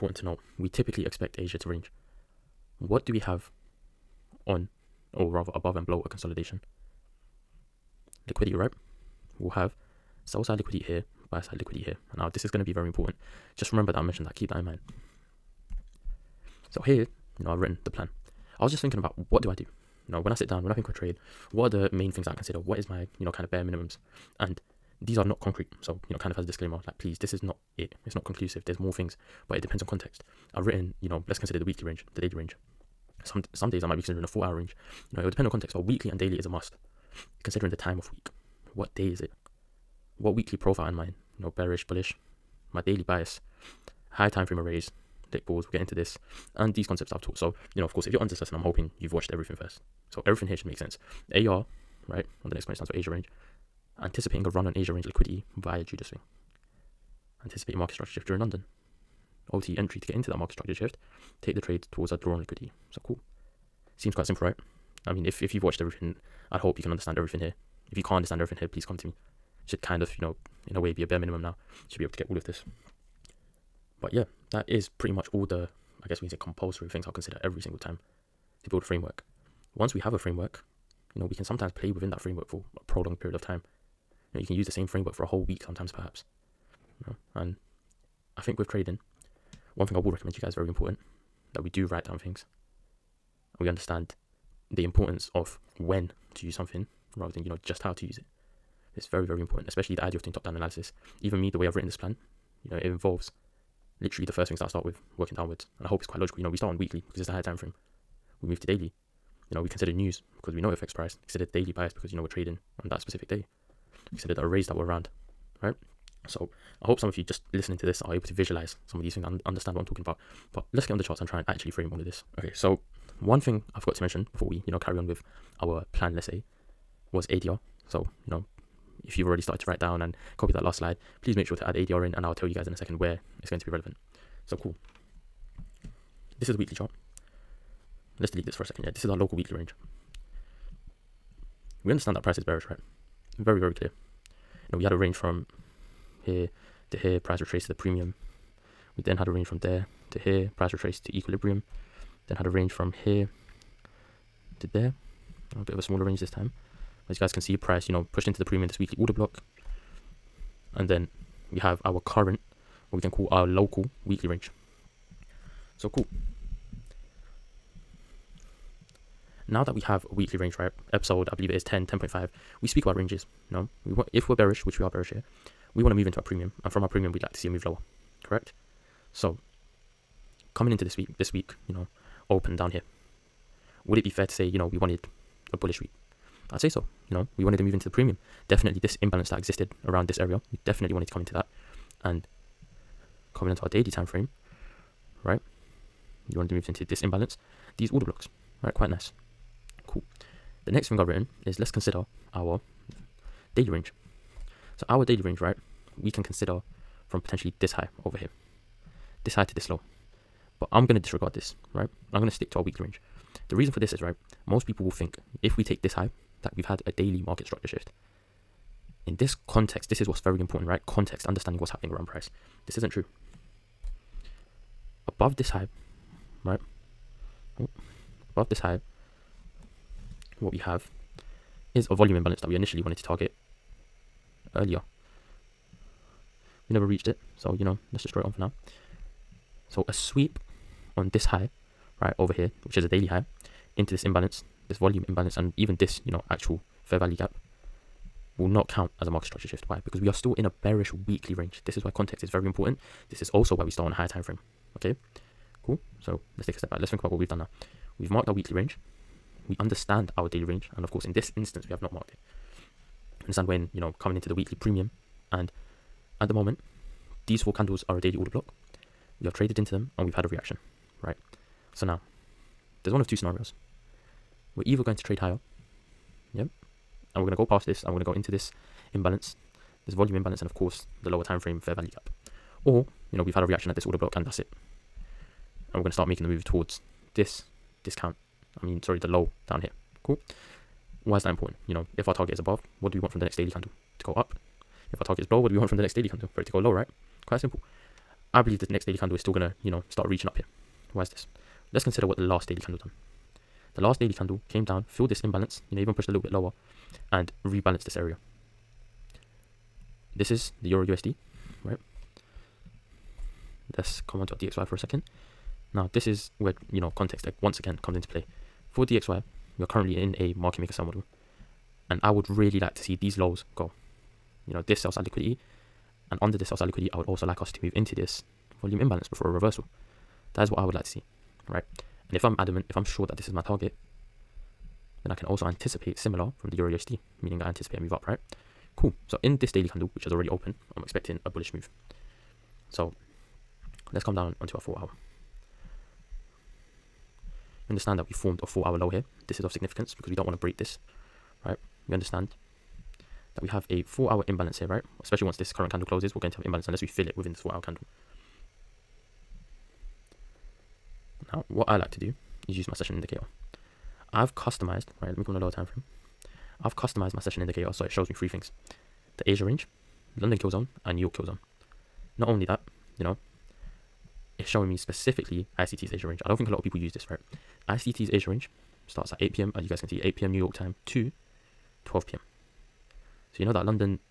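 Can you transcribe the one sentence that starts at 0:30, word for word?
I've written, you know, let's consider the weekly range, the daily range.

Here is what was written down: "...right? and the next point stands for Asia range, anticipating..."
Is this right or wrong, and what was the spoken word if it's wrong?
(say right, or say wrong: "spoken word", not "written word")
right.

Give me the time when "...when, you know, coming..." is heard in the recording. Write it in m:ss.
4:23.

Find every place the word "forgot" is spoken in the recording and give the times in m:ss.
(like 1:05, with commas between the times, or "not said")
2:03.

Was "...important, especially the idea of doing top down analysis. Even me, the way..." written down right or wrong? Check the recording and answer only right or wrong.
right.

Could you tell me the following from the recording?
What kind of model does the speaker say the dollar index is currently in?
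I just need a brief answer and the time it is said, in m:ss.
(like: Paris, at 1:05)
market maker sell model, at 5:20.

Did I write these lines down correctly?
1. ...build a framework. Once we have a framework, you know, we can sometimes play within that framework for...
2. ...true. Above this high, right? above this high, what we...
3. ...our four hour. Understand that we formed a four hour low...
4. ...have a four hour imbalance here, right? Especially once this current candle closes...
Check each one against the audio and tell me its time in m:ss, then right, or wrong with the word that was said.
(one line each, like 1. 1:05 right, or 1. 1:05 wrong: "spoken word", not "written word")
1. 1:18 right
2. 3:42 right
3. 5:44 right
4. 5:53 right.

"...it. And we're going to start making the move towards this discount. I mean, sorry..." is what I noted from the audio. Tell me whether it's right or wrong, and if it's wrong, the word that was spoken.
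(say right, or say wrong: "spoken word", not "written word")
right.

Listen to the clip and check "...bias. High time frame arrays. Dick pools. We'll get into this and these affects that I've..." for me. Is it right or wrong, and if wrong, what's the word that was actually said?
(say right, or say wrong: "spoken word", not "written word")
wrong: "concepts", not "affects".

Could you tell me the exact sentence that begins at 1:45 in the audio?
And I hope it's quite logical.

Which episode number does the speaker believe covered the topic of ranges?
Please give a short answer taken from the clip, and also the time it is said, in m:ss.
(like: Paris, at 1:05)
10.5, at 2:51.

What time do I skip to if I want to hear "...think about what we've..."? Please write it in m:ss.
4:16.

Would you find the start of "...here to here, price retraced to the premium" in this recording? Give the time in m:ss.
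2:26.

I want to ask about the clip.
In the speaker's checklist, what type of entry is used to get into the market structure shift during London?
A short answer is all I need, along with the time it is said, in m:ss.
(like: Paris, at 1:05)
OTE, at 0:59.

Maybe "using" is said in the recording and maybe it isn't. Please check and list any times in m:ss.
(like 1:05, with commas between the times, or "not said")
not said.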